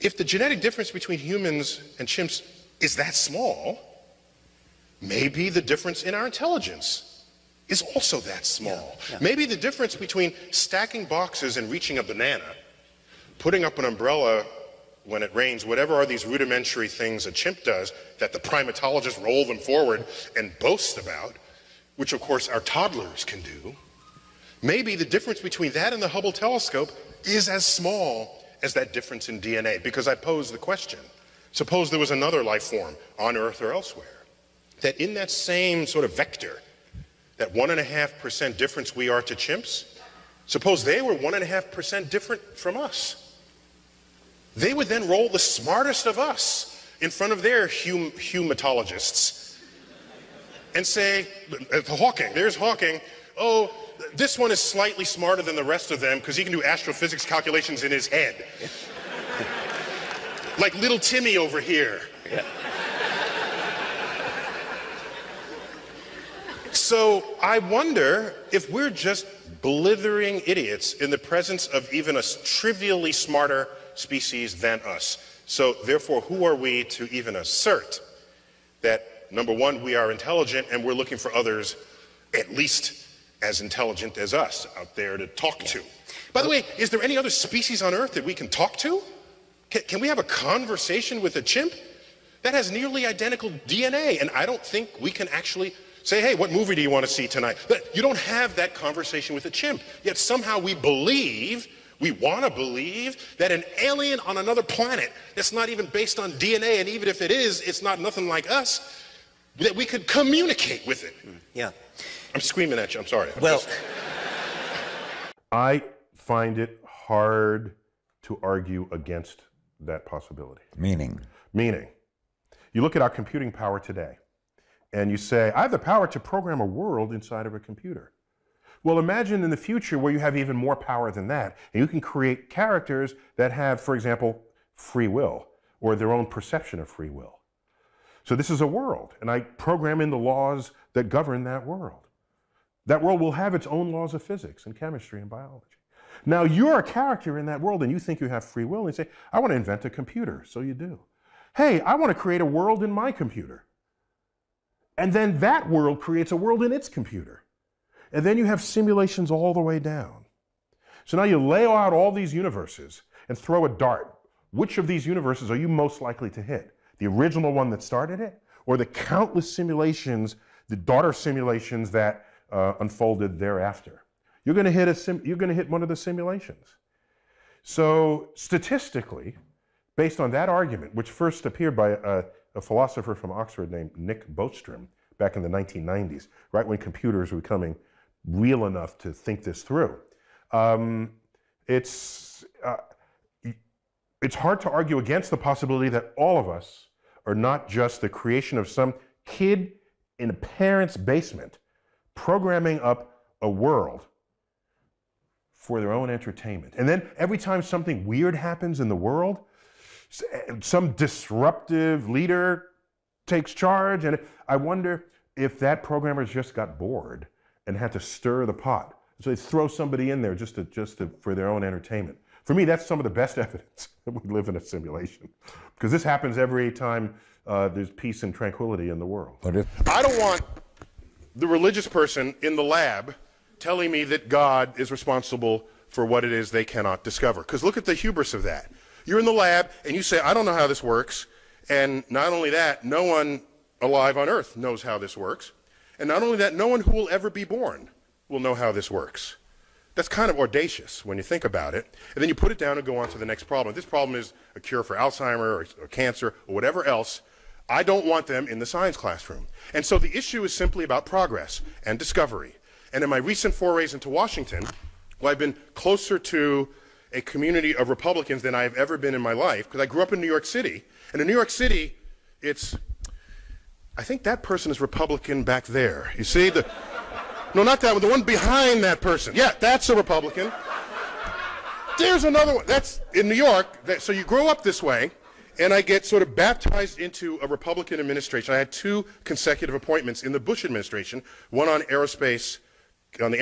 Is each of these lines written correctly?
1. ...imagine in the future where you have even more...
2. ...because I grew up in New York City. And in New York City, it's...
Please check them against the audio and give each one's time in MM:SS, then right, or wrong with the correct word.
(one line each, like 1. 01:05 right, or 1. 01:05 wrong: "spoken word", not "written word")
1. 02:08 right
2. 04:29 right.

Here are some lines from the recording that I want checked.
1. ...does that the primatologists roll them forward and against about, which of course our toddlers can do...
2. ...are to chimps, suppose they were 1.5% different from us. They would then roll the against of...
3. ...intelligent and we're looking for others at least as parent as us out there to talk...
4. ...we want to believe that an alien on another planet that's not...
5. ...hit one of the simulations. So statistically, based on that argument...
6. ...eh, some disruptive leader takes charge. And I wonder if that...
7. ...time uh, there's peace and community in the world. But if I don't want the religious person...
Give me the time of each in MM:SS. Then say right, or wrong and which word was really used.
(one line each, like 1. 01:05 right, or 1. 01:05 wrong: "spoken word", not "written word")
1. 00:17 wrong: "boast", not "against"
2. 00:39 wrong: "smartest", not "against"
3. 01:20 wrong: "intelligent", not "parent"
4. 01:42 right
5. 02:55 right
6. 03:30 right
7. 03:46 wrong: "tranquility", not "community".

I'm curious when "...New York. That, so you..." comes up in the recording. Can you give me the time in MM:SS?
04:43.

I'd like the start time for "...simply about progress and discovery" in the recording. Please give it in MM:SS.
04:20.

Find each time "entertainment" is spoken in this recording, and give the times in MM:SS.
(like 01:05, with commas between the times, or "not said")
03:26, 03:41.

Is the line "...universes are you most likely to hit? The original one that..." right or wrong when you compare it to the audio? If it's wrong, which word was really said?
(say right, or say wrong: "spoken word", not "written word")
right.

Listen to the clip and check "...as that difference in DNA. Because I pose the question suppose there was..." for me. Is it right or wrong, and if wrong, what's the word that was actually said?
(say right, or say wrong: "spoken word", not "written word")
right.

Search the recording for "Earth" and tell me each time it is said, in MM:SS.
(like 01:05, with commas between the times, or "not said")
00:33, 01:27, 04:04.